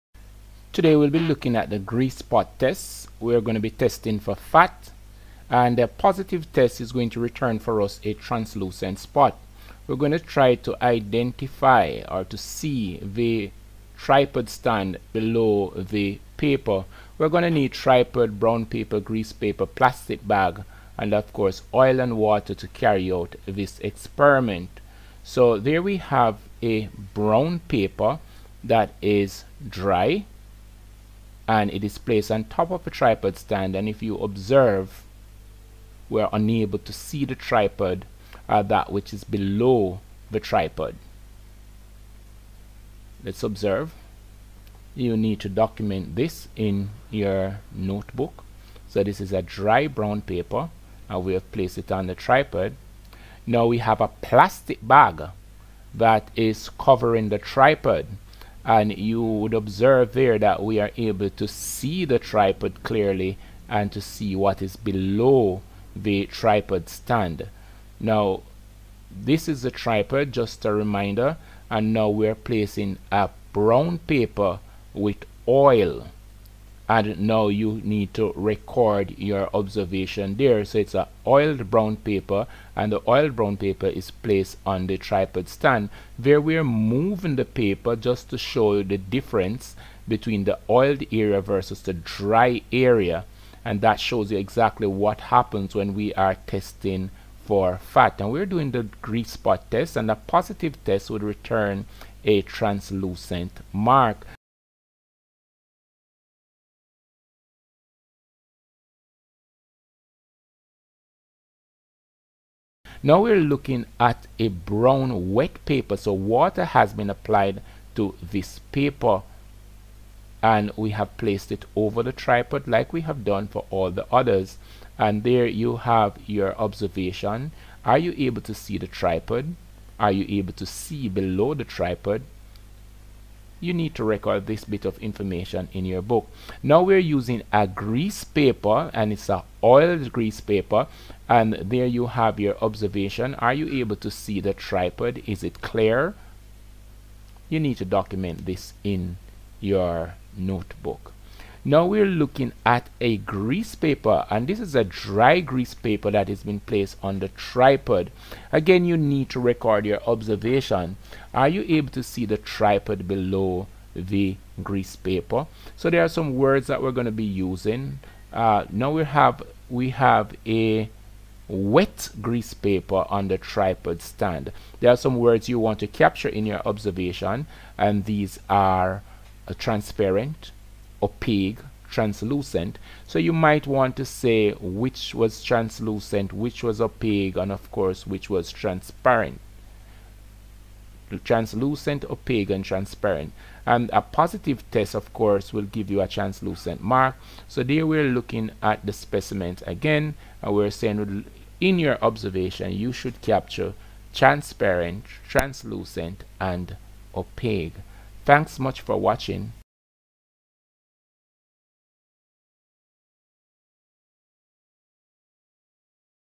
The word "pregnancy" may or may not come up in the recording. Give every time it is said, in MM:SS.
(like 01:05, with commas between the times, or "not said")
not said.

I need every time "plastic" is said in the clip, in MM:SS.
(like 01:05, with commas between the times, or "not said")
00:19, 00:54.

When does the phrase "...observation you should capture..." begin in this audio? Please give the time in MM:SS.
03:22.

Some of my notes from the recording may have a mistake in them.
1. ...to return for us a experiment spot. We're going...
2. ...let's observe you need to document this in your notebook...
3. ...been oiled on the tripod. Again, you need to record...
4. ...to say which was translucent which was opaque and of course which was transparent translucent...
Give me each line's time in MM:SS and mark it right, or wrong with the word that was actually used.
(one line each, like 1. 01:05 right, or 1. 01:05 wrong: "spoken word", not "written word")
1. 00:07 wrong: "translucent", not "experiment"
2. 00:43 right
3. 02:36 wrong: "placed", not "oiled"
4. 03:03 right.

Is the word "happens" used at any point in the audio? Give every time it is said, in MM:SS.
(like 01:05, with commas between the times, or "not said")
01:35.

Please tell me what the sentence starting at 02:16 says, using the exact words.
Now we're using a grease paper and it's a oiled grease paper and there you have your observation.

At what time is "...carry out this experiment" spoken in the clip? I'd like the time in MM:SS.
00:22.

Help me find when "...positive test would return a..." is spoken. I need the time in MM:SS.
01:40.